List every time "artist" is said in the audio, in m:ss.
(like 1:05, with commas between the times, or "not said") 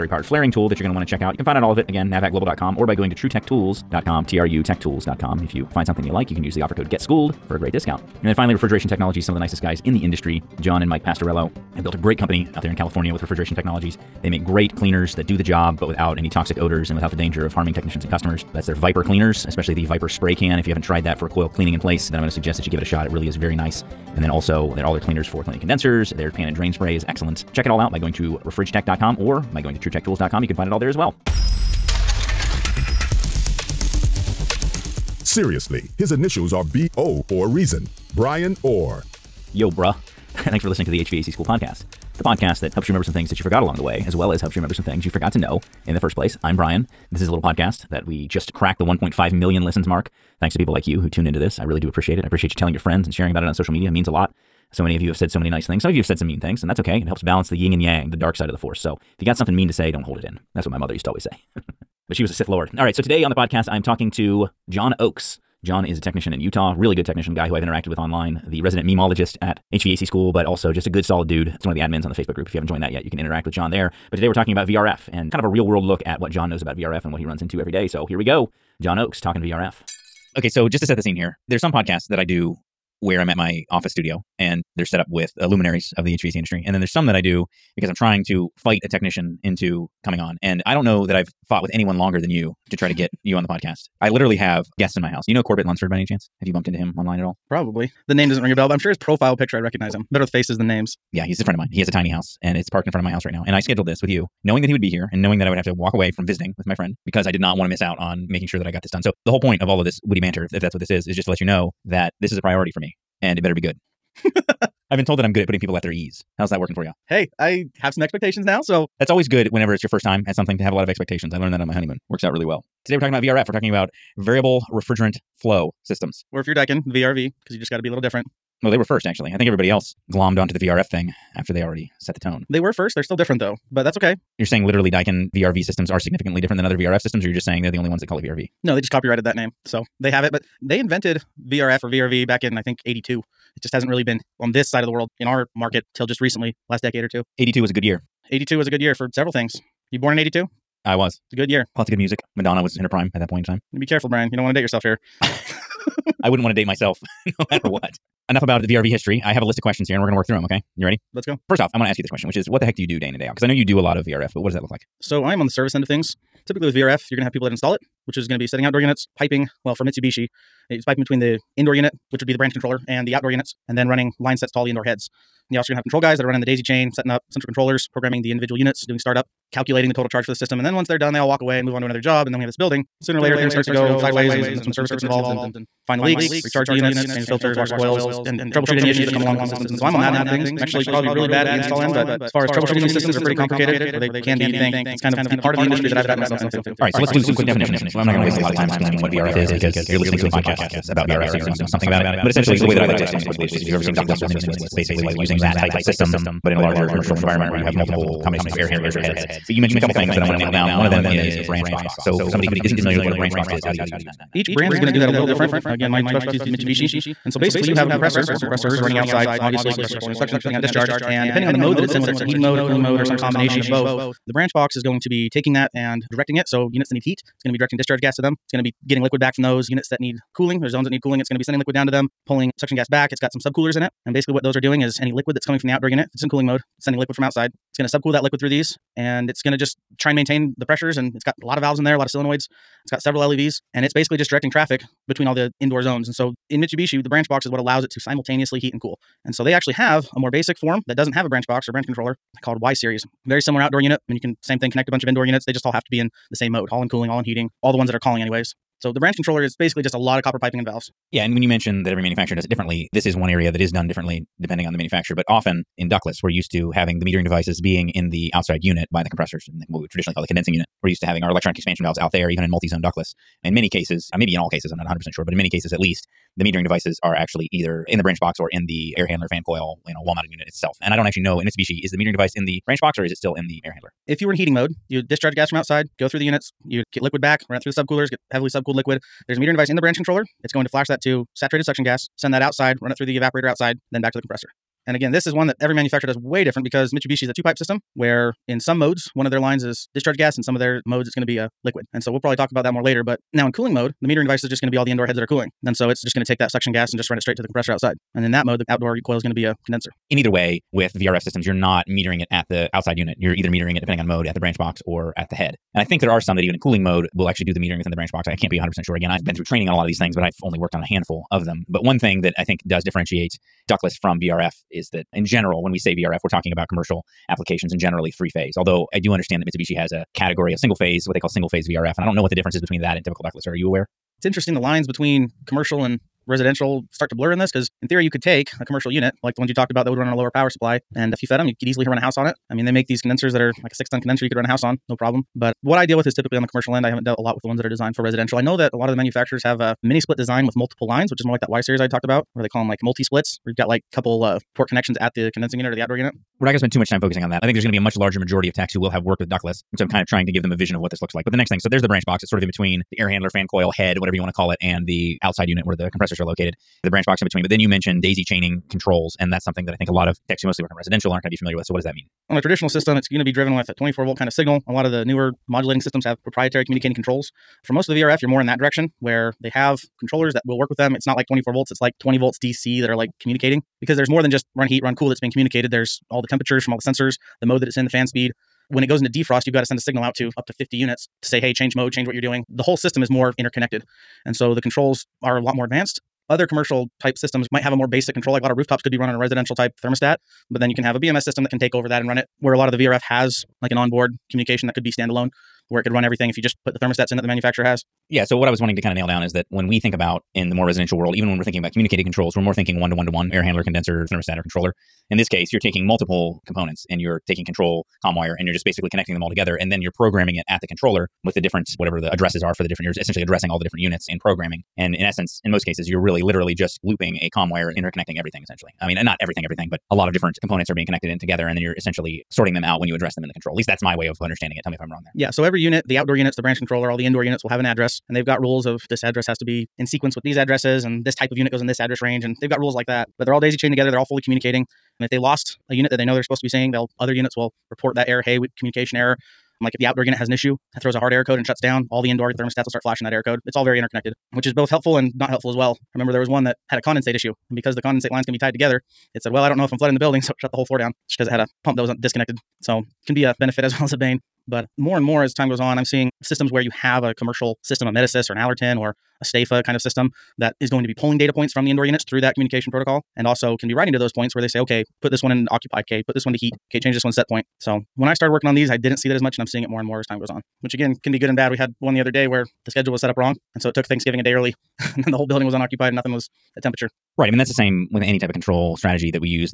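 not said.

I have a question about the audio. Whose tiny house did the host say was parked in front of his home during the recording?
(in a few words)
Corbett Lunsford.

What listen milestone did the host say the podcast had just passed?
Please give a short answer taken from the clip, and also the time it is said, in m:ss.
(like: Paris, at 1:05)
1.5 million, at 0:48.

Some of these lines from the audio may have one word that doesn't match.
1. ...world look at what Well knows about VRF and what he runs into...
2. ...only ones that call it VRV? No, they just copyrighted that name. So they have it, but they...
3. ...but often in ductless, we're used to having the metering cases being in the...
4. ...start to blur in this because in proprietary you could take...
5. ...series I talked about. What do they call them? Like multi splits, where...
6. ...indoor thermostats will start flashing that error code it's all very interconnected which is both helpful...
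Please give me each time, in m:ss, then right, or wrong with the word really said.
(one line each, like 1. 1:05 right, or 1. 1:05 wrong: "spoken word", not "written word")
1. 1:15 wrong: "John", not "Well"
2. 2:17 right
3. 4:25 wrong: "devices", not "cases"
4. 5:36 wrong: "theory", not "proprietary"
5. 5:51 right
6. 7:32 right.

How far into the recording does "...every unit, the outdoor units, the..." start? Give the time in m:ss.
7:15.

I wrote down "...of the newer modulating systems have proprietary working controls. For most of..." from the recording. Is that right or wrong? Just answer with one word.
wrong.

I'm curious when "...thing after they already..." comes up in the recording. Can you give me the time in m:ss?
2:10.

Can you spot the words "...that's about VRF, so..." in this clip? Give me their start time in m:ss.
3:20.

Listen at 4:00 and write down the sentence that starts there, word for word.
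And it's got a lot of valves in there, a lot of solenoids.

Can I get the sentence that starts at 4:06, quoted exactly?
And so in Mitsubishi, the branch box is what allows it to simultaneously heat and cool.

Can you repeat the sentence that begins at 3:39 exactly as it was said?
Obviously, compressors pulling in suction, putting out discharge.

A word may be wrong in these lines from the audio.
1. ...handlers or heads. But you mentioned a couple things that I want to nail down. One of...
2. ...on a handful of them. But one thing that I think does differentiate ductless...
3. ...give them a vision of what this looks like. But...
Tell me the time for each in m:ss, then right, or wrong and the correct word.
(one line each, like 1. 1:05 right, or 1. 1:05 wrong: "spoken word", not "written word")
1. 3:28 right
2. 5:20 right
3. 6:00 right.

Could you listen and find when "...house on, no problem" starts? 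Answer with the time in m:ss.
5:44.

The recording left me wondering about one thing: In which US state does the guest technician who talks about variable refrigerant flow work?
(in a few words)
Utah.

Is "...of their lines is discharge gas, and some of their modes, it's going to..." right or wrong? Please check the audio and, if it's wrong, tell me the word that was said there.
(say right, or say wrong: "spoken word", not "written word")
right.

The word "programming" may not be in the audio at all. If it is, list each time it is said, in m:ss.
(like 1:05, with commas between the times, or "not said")
2:57, 6:59, 7:04.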